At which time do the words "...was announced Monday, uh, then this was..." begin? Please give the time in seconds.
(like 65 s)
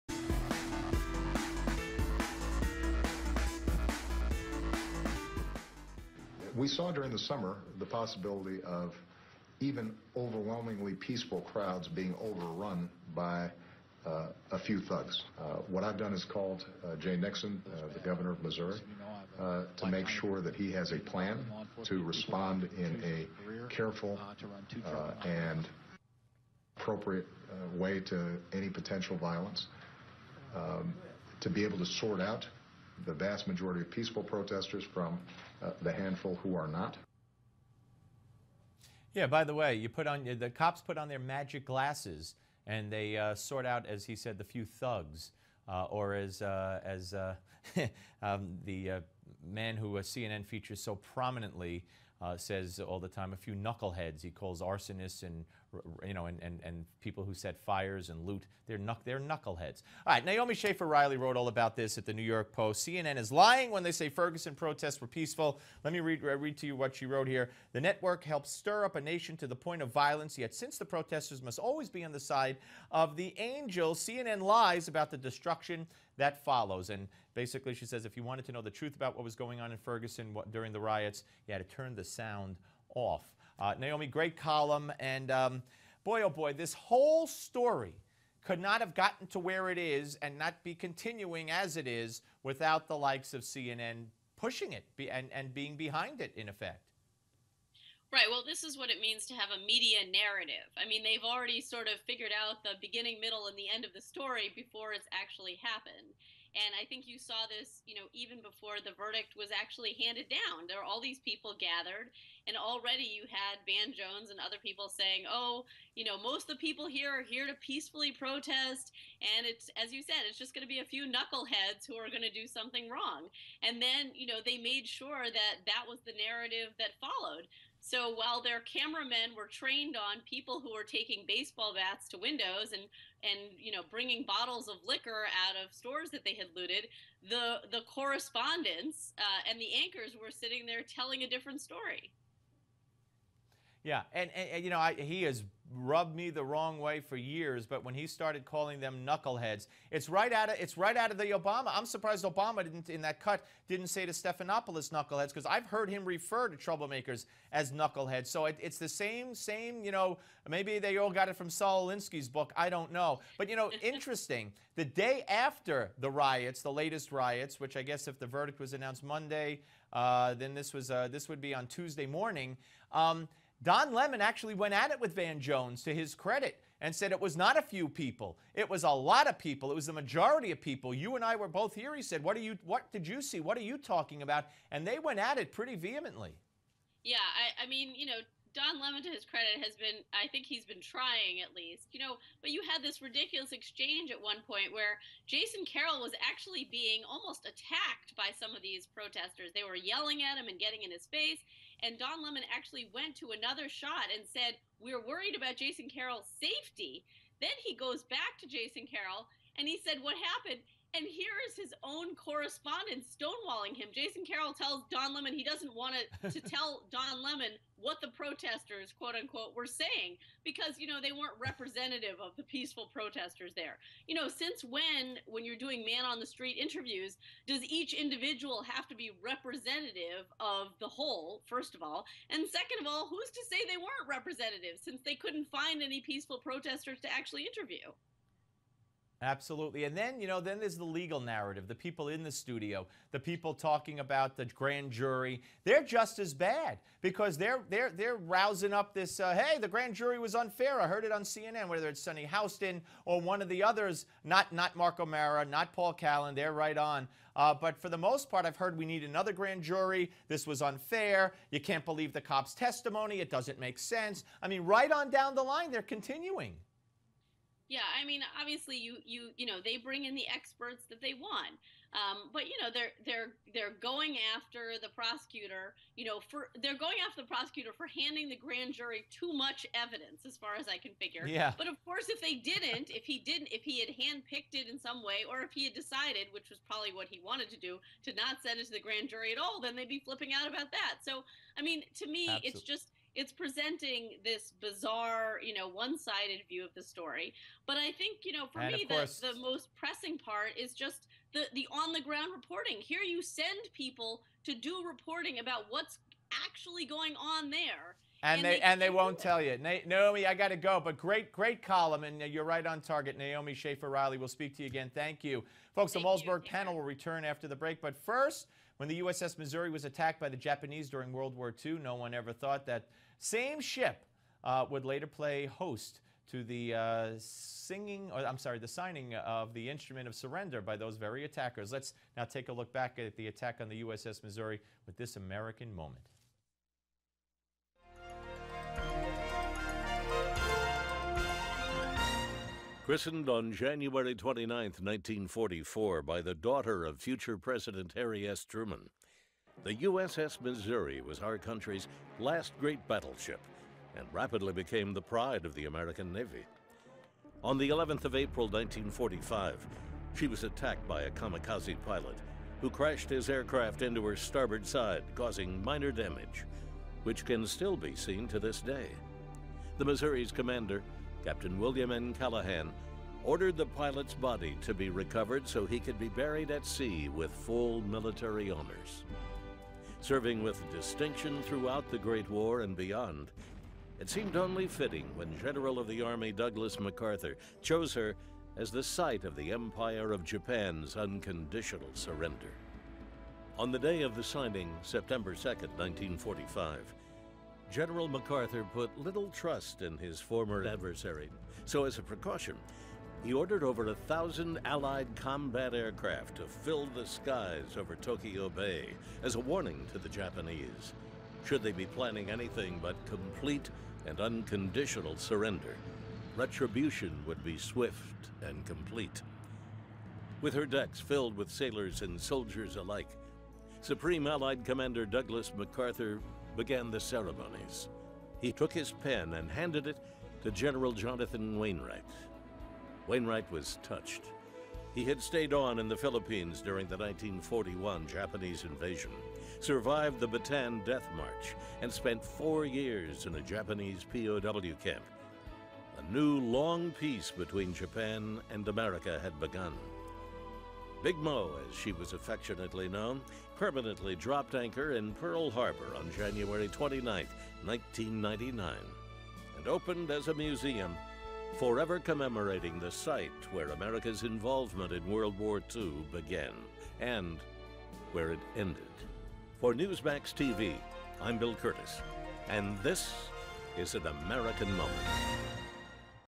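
168 s.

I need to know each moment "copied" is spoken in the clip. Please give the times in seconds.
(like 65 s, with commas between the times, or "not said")
not said.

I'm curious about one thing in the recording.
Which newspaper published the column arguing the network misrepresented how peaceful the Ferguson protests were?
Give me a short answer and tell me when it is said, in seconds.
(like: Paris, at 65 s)
New York Post, at 62 s.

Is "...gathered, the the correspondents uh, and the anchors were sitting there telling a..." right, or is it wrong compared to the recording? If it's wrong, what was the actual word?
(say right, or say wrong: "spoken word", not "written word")
wrong: "looted", not "gathered".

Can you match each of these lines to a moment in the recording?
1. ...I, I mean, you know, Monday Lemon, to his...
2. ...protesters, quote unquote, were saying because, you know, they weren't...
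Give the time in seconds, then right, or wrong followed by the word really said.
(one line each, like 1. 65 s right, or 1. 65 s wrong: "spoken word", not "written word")
1. 187 s wrong: "Don", not "Monday"
2. 218 s right.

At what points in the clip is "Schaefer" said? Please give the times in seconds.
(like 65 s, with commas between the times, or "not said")
60 s, 313 s.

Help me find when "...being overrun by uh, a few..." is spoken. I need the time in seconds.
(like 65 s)
11 s.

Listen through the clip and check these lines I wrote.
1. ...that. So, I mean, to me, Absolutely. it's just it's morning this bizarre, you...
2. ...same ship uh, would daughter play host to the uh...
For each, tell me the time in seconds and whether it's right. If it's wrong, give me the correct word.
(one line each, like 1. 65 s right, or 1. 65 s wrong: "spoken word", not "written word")
1. 290 s wrong: "presenting", not "morning"
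2. 323 s wrong: "later", not "daughter".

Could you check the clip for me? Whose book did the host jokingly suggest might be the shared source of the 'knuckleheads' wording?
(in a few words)
Saul Alinsky.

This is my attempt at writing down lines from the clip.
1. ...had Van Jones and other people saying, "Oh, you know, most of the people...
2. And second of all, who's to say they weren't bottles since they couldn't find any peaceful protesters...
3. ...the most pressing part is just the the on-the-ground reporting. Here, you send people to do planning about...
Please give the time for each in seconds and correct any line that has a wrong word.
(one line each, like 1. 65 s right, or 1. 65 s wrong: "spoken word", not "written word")
1. 113 s right
2. 232 s wrong: "representatives", not "bottles"
3. 299 s wrong: "reporting", not "planning".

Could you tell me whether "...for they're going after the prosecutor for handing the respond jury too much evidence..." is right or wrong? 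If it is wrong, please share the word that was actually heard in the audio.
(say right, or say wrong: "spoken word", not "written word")
wrong: "grand", not "respond".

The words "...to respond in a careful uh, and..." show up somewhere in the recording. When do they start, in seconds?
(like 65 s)
21 s.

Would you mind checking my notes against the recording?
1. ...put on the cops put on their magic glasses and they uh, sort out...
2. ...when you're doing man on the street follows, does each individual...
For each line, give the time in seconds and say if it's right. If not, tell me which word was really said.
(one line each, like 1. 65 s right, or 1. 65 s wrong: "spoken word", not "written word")
1. 39 s right
2. 225 s wrong: "interviews", not "follows".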